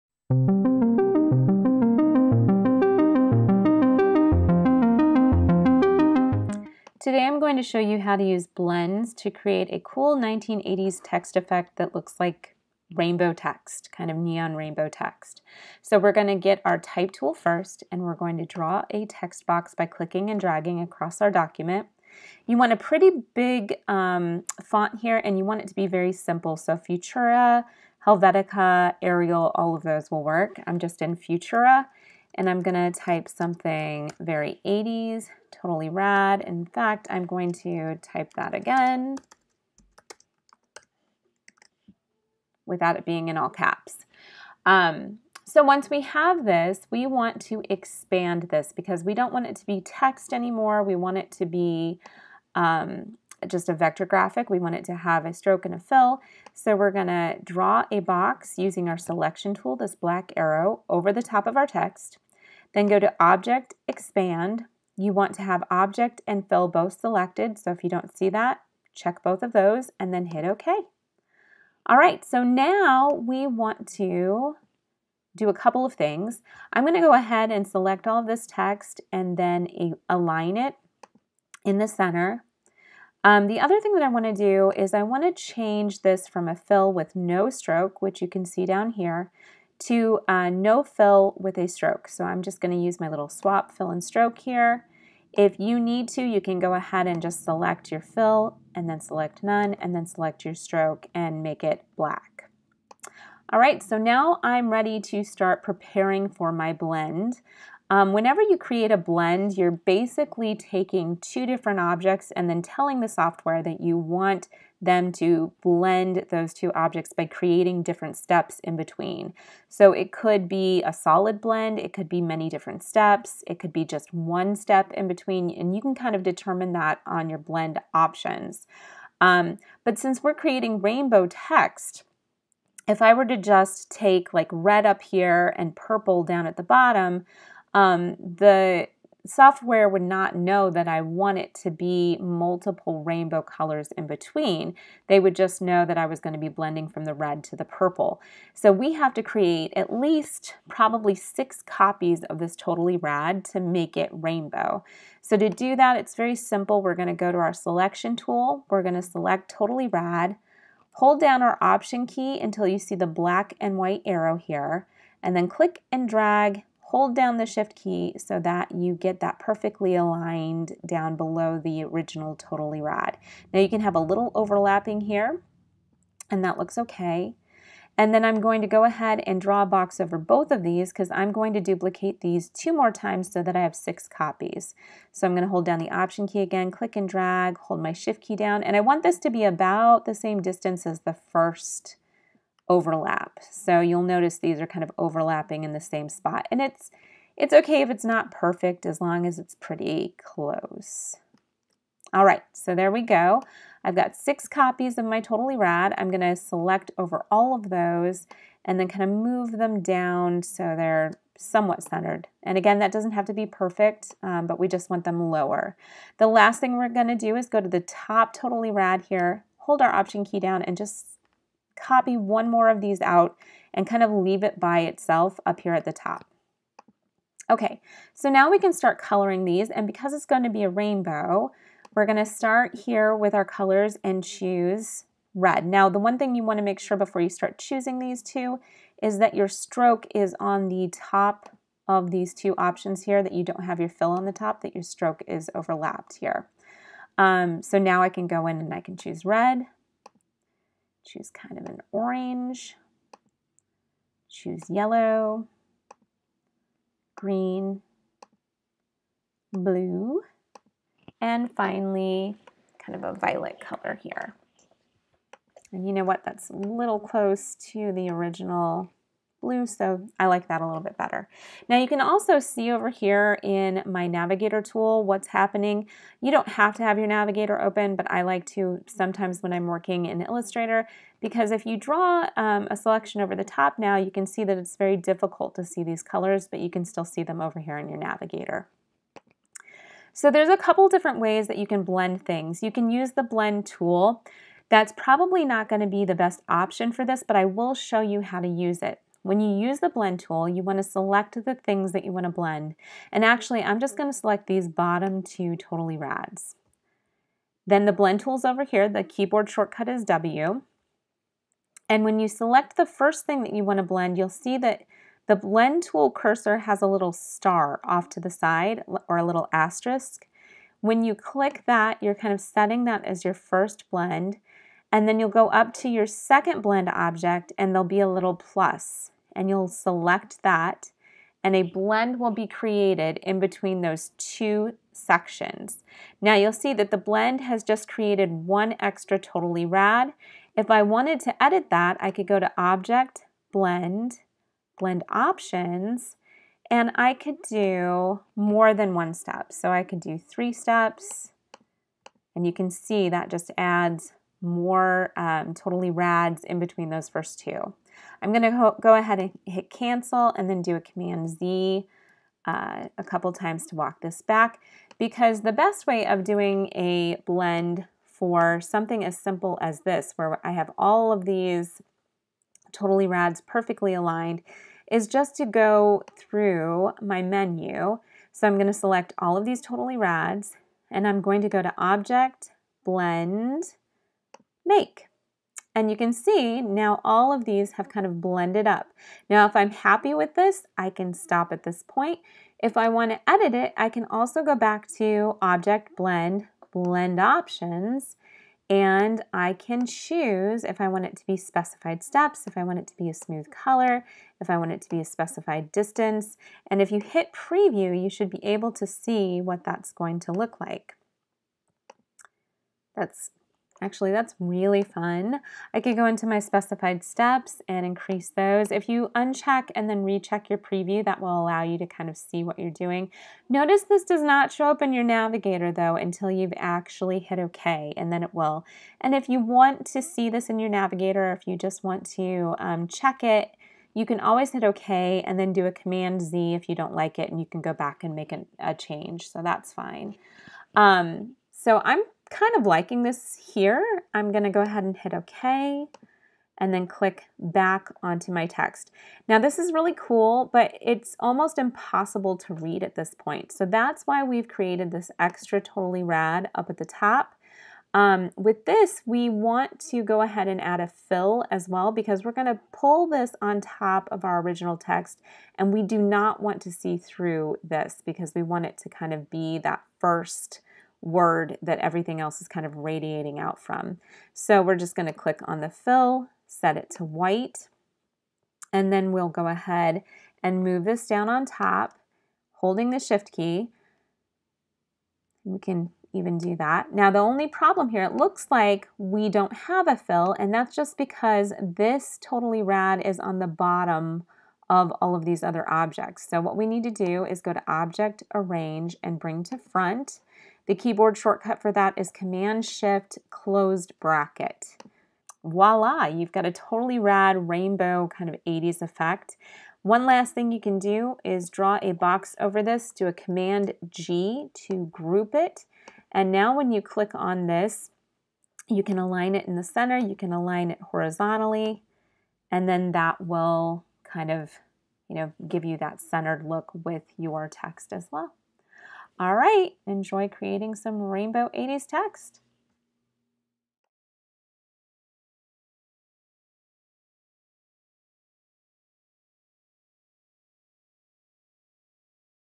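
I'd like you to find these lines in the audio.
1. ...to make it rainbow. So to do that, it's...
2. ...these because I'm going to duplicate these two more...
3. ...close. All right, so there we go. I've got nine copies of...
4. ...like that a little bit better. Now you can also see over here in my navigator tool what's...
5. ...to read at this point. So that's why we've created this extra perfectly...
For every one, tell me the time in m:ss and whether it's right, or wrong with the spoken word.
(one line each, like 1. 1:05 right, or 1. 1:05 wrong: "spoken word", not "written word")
1. 2:33 right
2. 3:00 right
3. 3:20 wrong: "six", not "nine"
4. 4:30 right
5. 7:32 wrong: "totally", not "perfectly".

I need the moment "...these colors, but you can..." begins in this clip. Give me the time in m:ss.
4:45.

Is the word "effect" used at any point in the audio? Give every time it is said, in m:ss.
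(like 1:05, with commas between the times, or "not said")
0:11, 8:28.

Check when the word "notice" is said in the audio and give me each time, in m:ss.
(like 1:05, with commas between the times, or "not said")
3:14, 7:03.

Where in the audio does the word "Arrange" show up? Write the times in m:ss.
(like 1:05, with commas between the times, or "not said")
8:18.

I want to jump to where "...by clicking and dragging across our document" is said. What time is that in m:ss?
0:19.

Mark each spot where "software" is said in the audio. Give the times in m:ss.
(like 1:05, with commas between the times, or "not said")
1:53, 2:19.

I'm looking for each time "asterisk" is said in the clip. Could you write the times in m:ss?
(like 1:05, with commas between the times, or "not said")
5:19.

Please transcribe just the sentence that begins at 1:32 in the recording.
So I'm just going to use my little swap fill and stroke here.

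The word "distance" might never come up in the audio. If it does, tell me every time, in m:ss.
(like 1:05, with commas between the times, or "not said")
3:10, 6:45.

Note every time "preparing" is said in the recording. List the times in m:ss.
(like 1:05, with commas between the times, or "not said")
1:45.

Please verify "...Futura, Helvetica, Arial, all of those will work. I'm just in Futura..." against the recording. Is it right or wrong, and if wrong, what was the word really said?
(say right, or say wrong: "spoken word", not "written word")
right.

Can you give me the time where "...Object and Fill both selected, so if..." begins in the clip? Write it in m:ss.
1:05.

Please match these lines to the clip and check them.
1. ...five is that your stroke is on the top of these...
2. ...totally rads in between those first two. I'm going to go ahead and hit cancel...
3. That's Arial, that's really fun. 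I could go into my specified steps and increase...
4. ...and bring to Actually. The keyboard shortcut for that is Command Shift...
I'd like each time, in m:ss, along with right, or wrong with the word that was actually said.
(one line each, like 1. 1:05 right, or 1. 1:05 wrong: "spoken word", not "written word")
1. 3:58 wrong: "two", not "five"
2. 5:55 right
3. 6:52 wrong: "Actually", not "Arial"
4. 8:19 wrong: "Front", not "Actually".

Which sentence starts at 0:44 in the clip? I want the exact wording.
Um, so once we have this, we want to expand this because we don't want it to be text anymore.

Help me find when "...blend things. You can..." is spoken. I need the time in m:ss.
4:51.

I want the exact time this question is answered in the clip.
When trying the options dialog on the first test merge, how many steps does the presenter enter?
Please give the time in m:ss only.
5:50.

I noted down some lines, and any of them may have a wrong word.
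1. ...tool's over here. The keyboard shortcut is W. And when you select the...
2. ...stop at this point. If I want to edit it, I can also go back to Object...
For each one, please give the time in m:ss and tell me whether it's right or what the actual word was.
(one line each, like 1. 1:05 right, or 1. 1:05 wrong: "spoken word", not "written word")
1. 5:08 right
2. 6:31 right.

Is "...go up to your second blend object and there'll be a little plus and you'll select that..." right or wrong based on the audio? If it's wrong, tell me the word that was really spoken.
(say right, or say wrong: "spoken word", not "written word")
right.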